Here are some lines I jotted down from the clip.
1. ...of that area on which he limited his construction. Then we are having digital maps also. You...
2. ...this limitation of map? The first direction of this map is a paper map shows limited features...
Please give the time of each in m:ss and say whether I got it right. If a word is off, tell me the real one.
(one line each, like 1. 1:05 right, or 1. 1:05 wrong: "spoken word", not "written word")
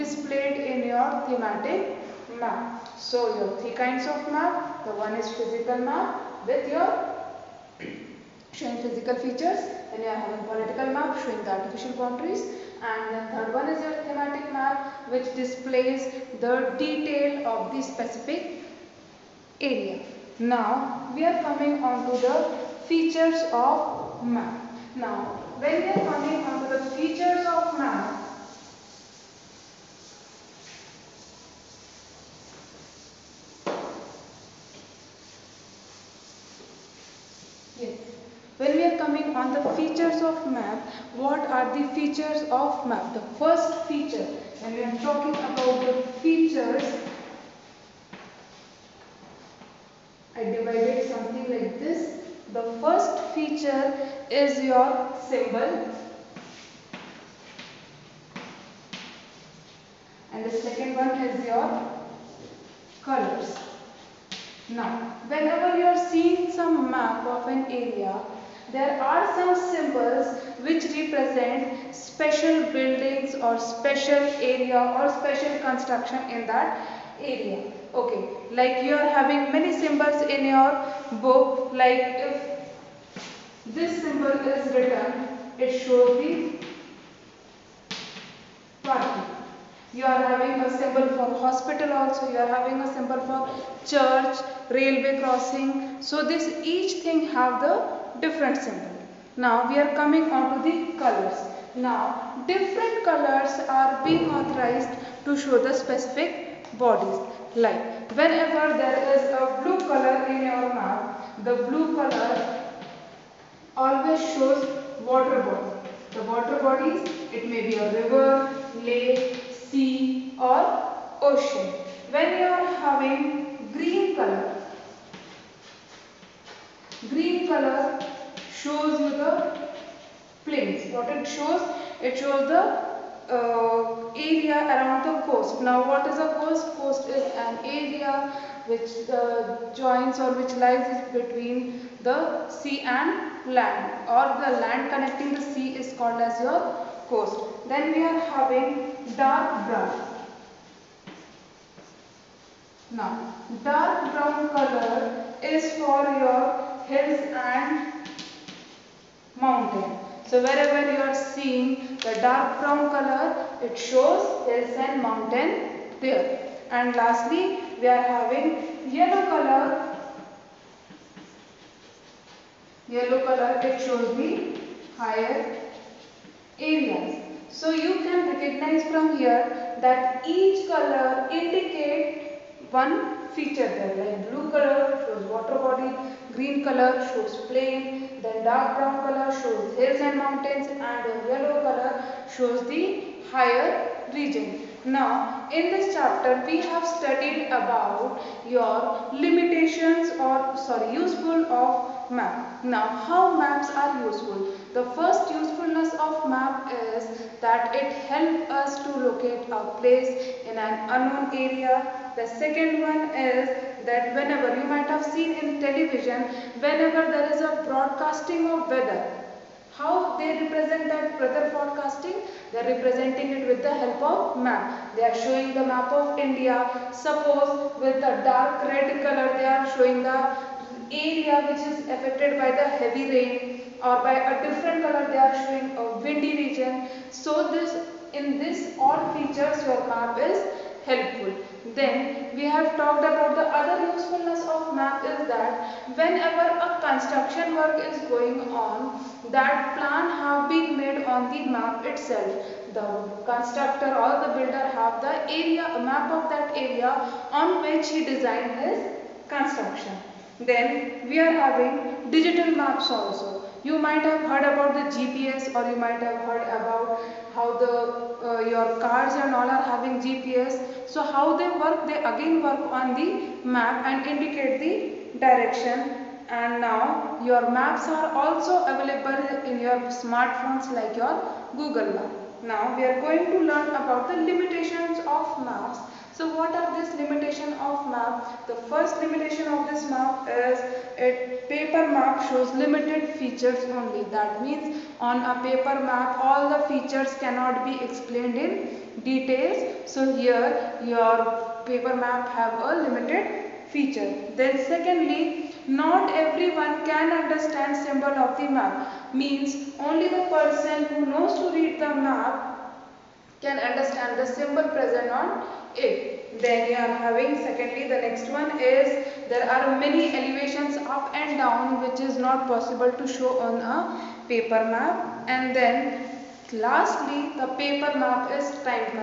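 1. 4:16 wrong: "designed", not "limited"
2. 4:46 wrong: "limitation", not "direction".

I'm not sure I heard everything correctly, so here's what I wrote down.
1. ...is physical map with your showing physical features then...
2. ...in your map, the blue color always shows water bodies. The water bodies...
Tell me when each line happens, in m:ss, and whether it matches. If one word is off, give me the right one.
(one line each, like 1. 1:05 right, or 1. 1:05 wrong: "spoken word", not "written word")
1. 0:05 right
2. 1:50 right.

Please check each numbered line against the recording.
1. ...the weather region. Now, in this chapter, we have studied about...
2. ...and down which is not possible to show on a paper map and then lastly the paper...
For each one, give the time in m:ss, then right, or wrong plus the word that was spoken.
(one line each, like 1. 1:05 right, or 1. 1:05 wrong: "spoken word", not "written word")
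1. 3:12 wrong: "higher", not "weather"
2. 5:21 right.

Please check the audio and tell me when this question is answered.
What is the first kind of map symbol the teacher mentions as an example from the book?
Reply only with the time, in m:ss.
1:28.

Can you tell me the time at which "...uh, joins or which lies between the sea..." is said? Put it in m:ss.
2:19.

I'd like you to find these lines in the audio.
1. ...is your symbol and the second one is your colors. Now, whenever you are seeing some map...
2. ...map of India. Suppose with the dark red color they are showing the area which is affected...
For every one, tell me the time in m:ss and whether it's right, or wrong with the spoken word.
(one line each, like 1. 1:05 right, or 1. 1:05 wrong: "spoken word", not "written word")
1. 0:54 right
2. 3:45 right.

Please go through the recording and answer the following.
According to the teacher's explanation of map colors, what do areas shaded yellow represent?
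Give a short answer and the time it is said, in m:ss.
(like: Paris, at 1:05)
Higher areas, at 2:54.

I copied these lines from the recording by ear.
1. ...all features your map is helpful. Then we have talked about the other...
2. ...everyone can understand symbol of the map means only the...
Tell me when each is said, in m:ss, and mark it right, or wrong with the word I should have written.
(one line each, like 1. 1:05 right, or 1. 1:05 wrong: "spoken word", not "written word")
1. 3:58 right
2. 5:06 right.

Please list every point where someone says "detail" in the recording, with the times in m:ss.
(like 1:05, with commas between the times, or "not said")
0:16, 4:59.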